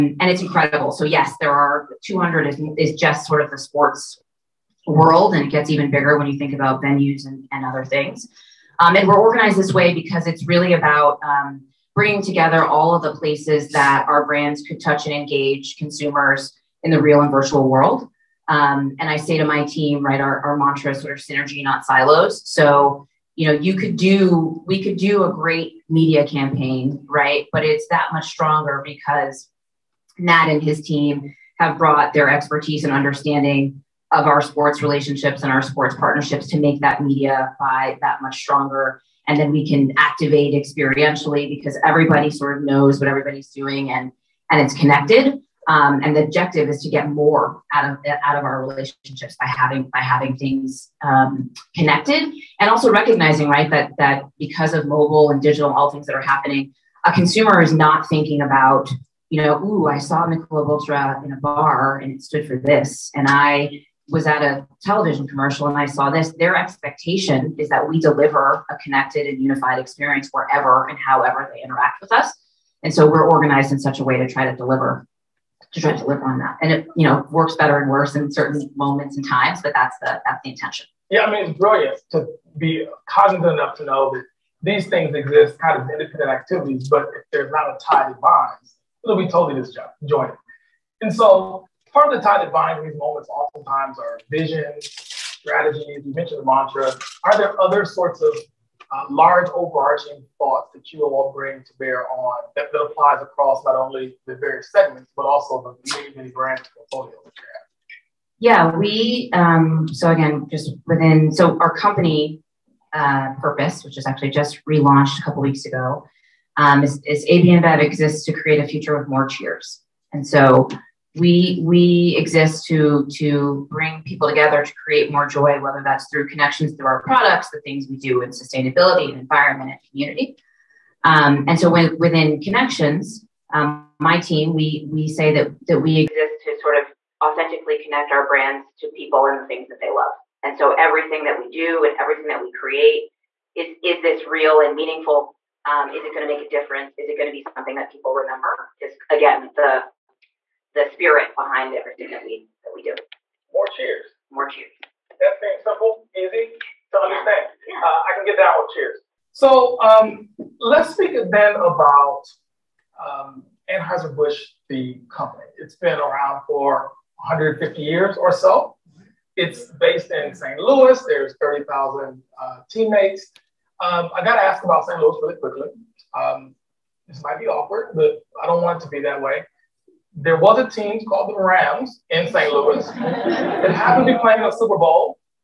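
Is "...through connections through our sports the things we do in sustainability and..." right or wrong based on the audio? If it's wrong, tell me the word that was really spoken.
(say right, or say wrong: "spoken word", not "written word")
wrong: "products", not "sports".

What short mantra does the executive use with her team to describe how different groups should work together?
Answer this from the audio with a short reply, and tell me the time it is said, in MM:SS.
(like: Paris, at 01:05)
Synergy, not silos, at 00:21.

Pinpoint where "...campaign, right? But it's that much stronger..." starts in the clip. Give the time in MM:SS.
00:26.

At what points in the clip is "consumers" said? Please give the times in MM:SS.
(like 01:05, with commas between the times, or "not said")
00:15, 00:57.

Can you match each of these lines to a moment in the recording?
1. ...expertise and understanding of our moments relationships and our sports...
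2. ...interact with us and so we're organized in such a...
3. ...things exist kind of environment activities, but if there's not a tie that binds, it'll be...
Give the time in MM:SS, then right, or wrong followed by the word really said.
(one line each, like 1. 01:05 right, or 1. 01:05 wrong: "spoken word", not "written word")
1. 00:32 wrong: "sports", not "moments"
2. 01:11 right
3. 01:24 wrong: "independent", not "environment".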